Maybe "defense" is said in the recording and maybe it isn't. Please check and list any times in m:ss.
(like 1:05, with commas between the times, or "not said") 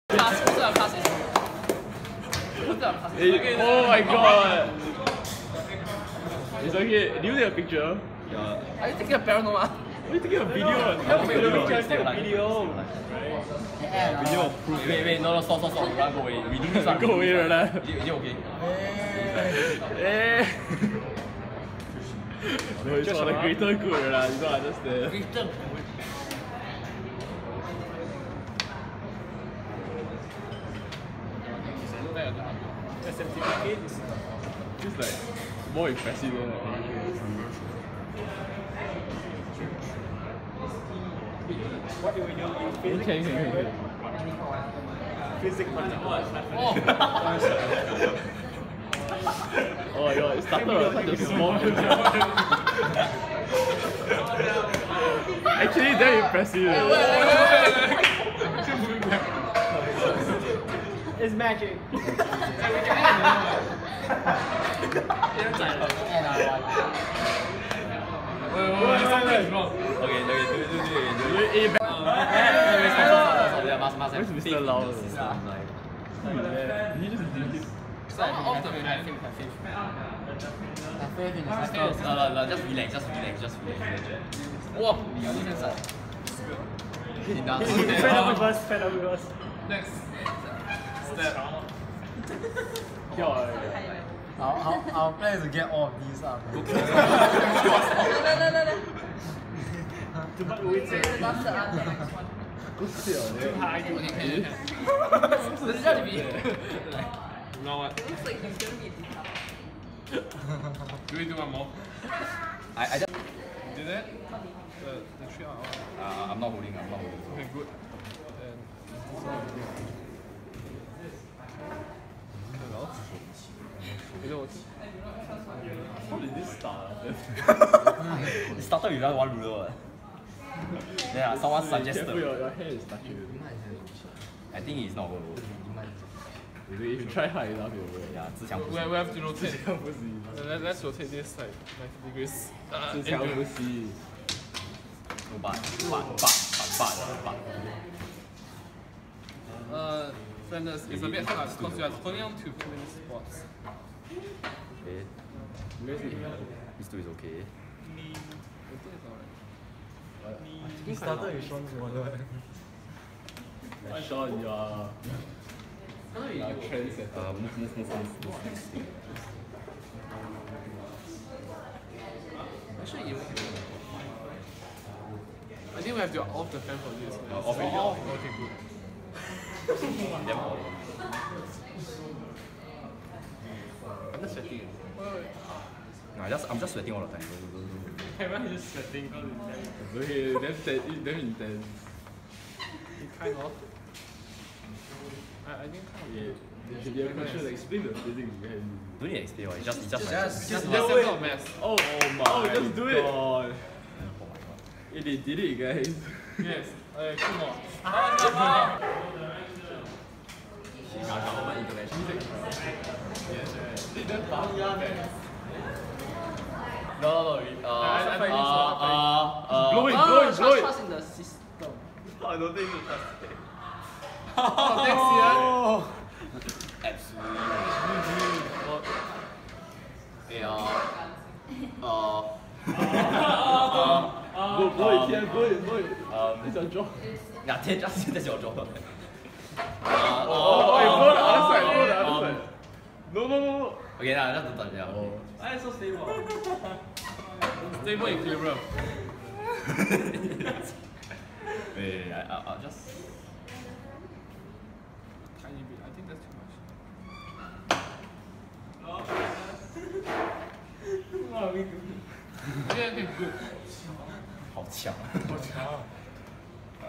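1:25.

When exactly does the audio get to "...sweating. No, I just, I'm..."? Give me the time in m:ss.
3:04.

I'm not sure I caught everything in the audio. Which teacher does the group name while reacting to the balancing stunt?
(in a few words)
Mr. Lau.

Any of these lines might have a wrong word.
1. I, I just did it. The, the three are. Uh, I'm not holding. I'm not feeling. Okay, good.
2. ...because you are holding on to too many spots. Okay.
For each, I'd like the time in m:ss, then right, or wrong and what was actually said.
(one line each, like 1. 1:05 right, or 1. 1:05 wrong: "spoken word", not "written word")
1. 1:52 wrong: "holding", not "feeling"
2. 2:31 right.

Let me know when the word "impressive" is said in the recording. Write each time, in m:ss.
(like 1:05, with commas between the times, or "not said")
0:35, 0:56.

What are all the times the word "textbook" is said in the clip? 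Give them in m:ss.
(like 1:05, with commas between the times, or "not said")
not said.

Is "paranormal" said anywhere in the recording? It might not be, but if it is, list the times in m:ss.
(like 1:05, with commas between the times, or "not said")
0:09.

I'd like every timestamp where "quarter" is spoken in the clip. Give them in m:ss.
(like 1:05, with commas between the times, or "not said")
not said.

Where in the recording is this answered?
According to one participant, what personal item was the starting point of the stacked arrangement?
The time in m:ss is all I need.
2:41.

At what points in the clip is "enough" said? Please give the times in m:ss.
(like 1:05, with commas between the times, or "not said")
2:17, 4:04.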